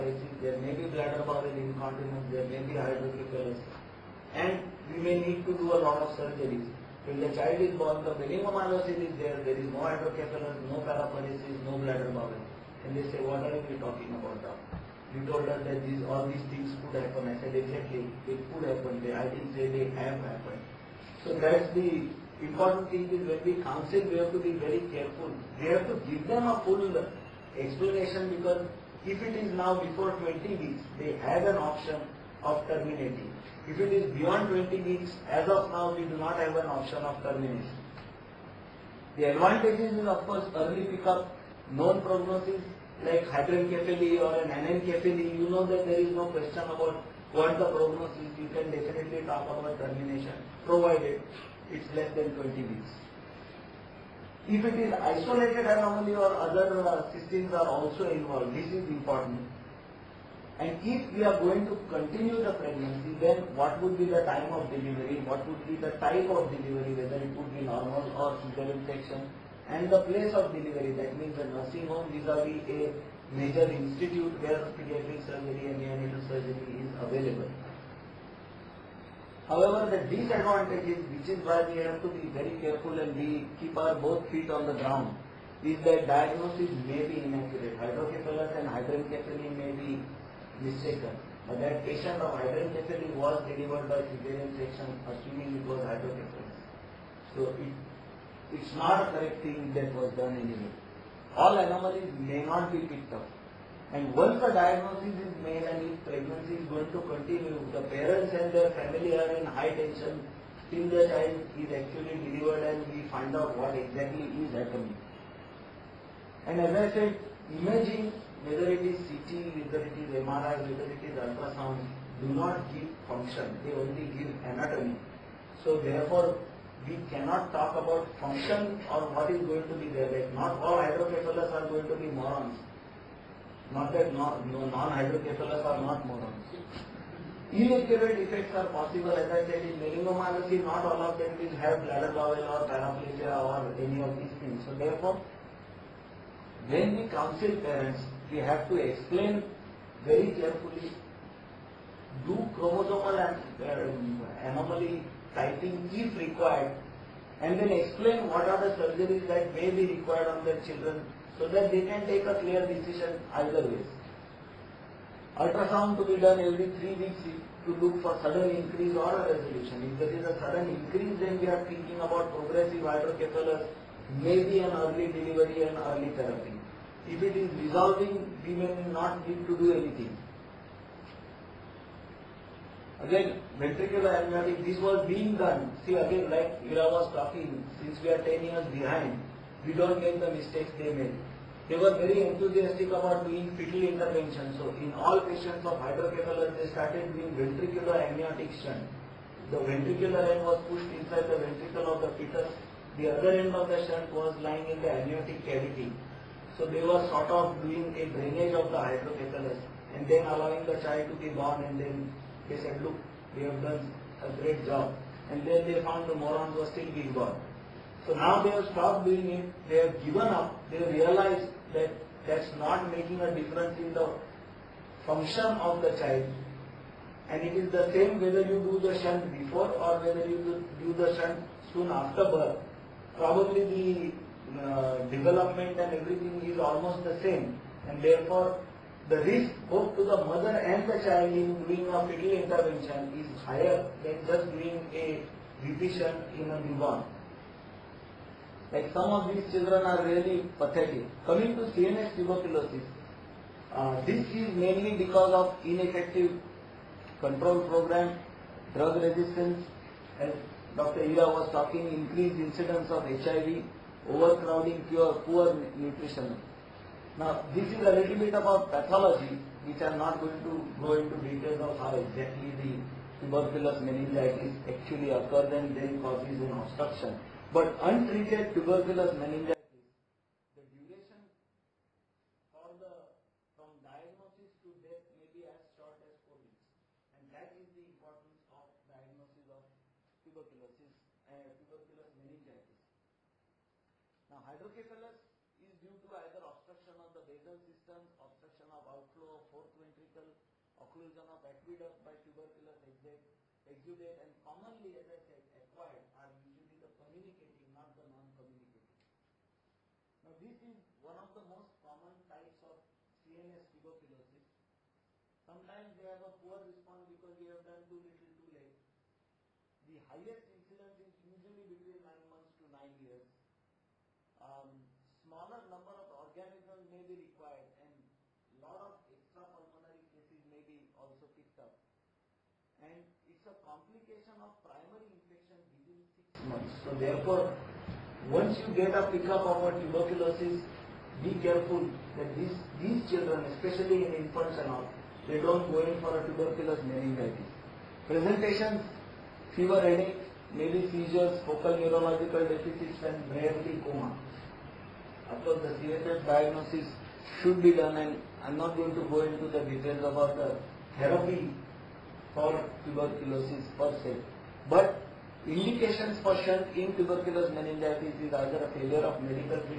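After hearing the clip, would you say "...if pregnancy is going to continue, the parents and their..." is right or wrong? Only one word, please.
right.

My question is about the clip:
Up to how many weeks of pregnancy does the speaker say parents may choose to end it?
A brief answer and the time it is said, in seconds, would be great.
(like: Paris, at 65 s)
20, at 29 s.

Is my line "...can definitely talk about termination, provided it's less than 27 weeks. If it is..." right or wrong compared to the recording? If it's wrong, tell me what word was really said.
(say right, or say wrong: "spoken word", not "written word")
wrong: "20", not "27".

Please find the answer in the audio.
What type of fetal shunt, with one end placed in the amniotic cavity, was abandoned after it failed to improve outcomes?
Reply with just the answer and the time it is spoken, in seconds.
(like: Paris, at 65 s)
Ventricular amniotic shunt, at 197 s.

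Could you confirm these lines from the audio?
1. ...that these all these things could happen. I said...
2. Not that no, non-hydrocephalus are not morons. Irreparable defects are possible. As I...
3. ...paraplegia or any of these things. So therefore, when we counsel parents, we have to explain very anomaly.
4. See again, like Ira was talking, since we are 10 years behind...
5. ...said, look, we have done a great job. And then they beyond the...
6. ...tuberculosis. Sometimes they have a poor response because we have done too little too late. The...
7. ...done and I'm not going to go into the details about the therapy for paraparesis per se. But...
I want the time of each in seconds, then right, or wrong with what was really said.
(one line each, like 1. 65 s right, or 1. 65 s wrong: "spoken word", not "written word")
1. 15 s right
2. 133 s right
3. 142 s wrong: "carefully", not "anomaly"
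4. 185 s right
5. 212 s wrong: "found", not "beyond"
6. 313 s right
7. 357 s wrong: "tuberculosis", not "paraparesis".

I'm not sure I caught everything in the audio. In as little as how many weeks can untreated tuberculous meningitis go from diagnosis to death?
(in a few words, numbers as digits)
4 weeks.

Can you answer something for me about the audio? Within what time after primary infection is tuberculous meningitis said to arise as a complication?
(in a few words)
Six months.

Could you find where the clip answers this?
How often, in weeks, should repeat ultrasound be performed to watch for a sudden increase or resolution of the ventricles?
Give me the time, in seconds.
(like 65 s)
166 s.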